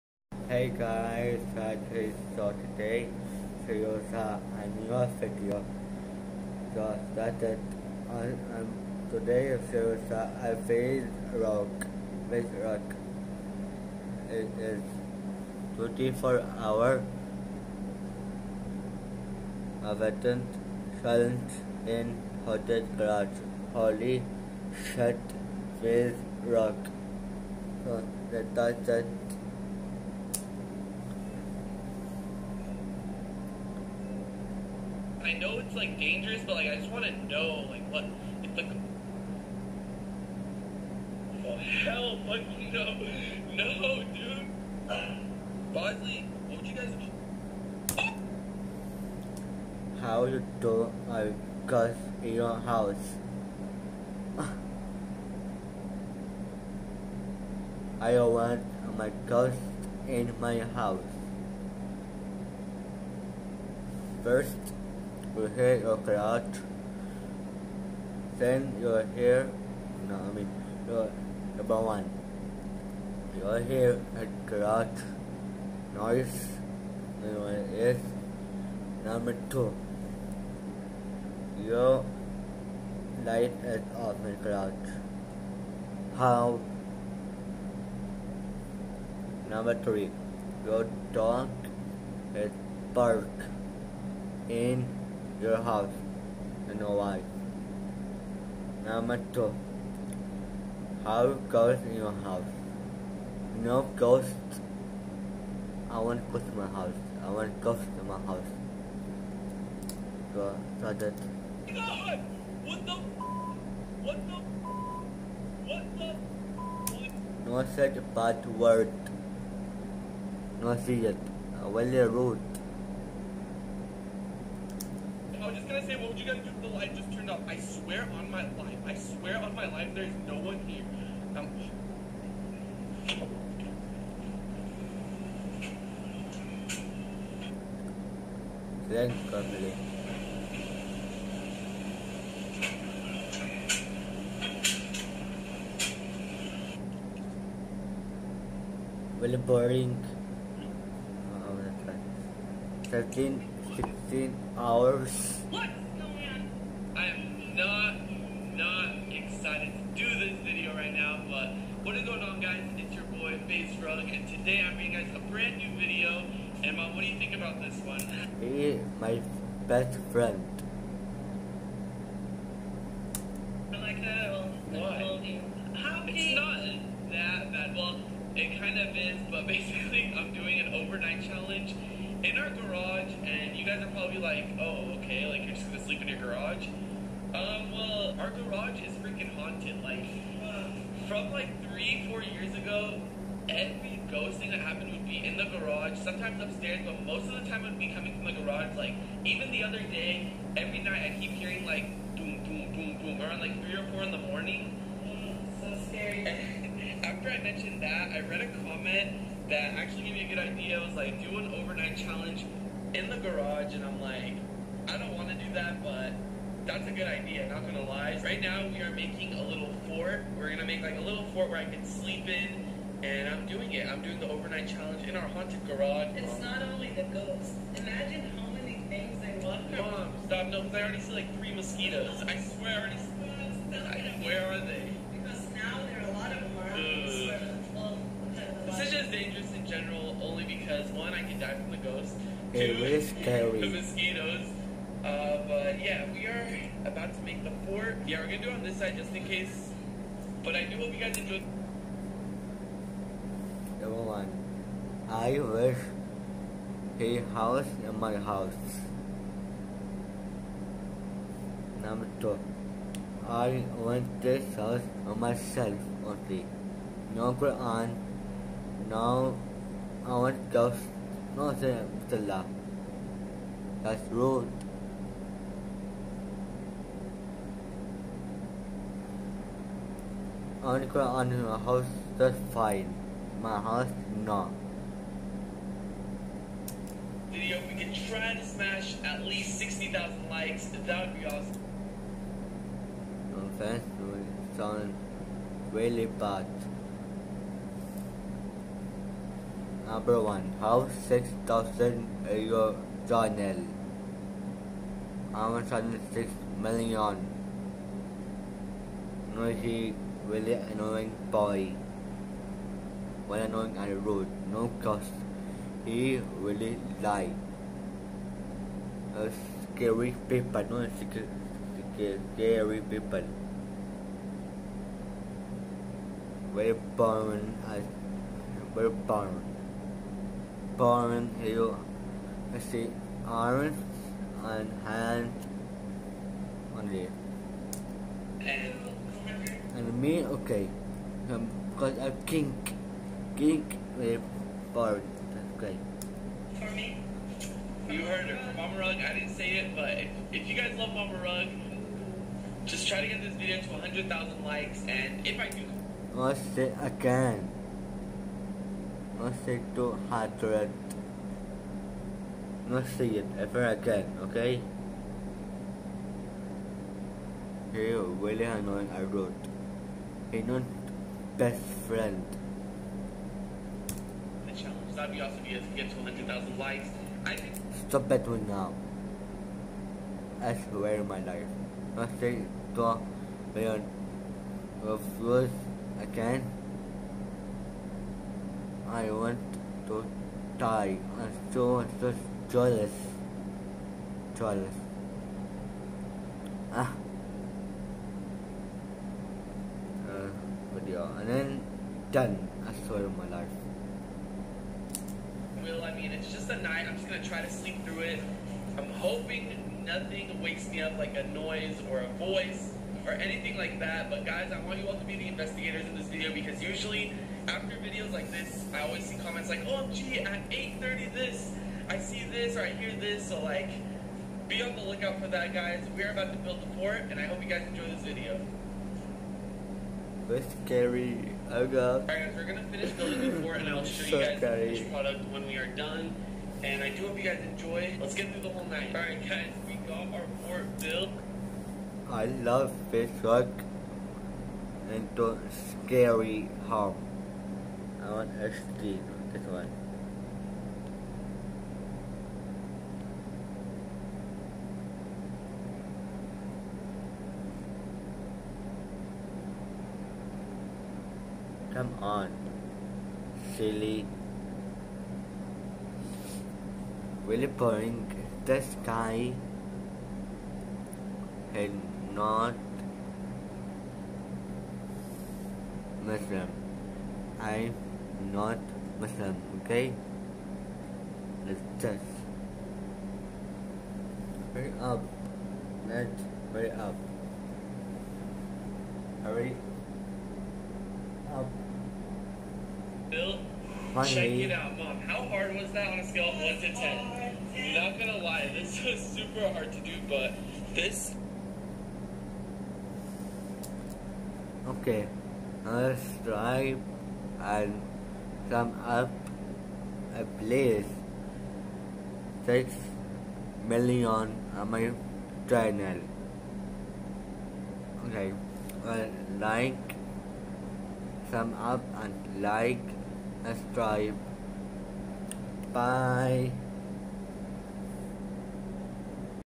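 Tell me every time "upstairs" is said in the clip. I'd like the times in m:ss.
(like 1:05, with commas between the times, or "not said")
3:16.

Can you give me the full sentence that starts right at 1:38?
Number two, how ghosts in your house.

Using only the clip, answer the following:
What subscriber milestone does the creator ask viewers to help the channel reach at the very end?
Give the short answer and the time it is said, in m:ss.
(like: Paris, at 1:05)
6 million, at 8:32.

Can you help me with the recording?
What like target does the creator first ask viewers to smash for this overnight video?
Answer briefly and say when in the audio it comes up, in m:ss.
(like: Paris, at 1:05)
60,000, at 4:49.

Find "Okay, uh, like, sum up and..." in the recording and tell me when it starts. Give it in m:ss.
8:38.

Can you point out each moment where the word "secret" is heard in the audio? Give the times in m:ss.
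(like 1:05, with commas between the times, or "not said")
5:20.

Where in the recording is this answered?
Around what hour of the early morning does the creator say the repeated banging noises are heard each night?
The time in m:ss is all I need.
3:23.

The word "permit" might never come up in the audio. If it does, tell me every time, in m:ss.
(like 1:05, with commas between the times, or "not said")
not said.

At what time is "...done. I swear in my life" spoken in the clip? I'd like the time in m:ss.
6:42.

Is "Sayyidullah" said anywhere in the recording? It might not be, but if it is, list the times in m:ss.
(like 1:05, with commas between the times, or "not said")
4:31.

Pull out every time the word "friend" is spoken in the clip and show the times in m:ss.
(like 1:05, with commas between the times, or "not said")
2:50, 6:11.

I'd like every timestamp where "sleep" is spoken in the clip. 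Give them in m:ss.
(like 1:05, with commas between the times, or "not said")
3:05, 3:41, 6:47.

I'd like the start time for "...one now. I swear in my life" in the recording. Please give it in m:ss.
6:18.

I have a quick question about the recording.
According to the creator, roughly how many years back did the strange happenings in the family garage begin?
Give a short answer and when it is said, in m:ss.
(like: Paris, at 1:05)
3 or 4 years, at 3:11.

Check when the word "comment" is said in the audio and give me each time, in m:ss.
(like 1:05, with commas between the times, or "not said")
3:28, 6:59.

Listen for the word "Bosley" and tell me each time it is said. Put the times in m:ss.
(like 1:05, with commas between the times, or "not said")
0:45.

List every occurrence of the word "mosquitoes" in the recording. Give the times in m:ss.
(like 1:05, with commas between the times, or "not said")
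3:51, 4:03.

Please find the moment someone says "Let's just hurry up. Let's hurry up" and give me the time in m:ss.
8:01.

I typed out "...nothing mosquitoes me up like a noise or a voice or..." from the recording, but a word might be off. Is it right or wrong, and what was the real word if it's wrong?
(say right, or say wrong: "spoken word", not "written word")
wrong: "wakes", not "mosquitoes".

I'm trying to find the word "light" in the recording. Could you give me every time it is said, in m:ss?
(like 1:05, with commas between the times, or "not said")
1:23, 2:06.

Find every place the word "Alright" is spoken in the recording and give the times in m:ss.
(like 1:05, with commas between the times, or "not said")
7:12, 7:18.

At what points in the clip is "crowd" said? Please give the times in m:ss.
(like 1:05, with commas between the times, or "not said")
1:05, 1:14, 1:24.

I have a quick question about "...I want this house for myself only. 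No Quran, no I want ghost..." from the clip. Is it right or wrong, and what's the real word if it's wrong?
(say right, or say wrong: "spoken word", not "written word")
right.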